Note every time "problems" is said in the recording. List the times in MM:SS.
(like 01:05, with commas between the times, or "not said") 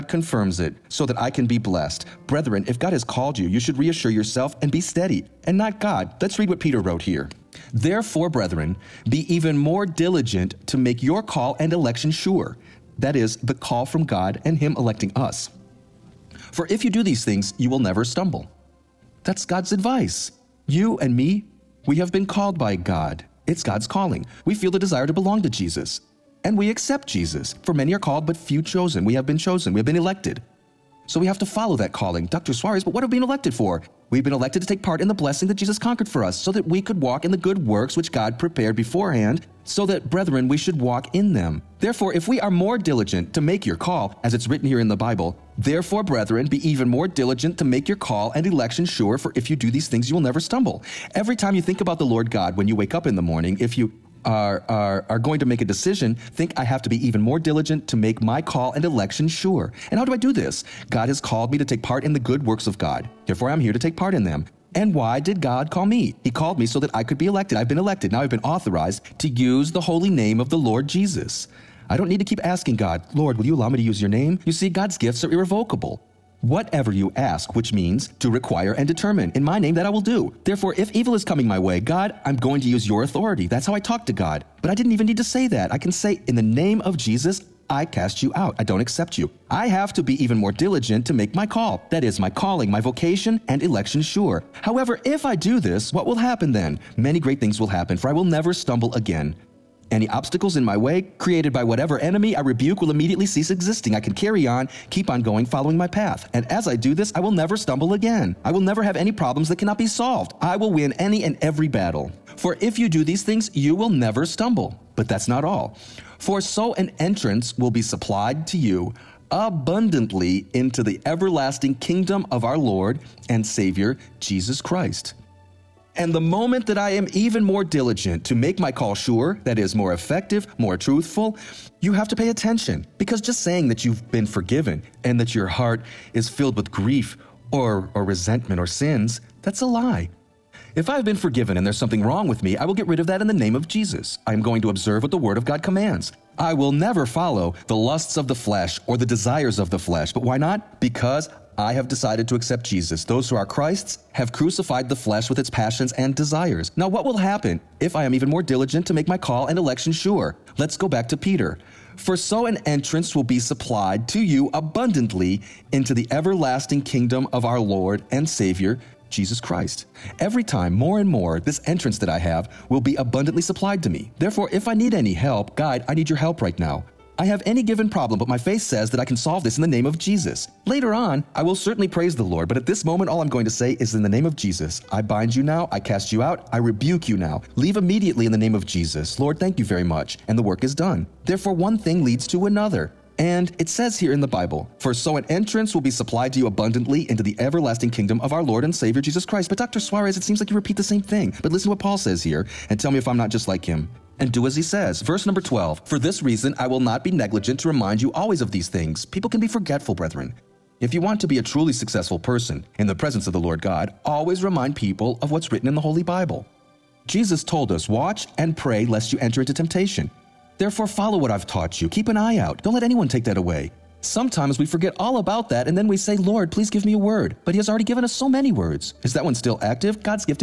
01:49, 02:57.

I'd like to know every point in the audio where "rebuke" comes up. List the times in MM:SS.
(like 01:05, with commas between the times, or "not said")
01:42, 03:06.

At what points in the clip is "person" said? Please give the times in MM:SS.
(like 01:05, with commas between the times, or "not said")
03:32.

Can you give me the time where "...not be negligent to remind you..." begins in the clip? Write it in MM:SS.
03:26.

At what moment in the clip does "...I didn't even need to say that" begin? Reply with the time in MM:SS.
01:24.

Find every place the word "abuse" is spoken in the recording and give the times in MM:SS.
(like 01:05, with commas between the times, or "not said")
not said.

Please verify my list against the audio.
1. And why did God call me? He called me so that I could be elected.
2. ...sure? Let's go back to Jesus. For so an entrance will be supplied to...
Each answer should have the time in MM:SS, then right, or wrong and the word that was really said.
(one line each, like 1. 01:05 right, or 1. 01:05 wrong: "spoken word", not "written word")
1. 01:04 right
2. 02:39 wrong: "Peter", not "Jesus".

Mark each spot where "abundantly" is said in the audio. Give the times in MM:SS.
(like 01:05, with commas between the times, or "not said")
01:59, 02:44, 02:52, 03:16.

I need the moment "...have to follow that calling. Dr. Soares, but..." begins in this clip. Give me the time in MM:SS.
00:31.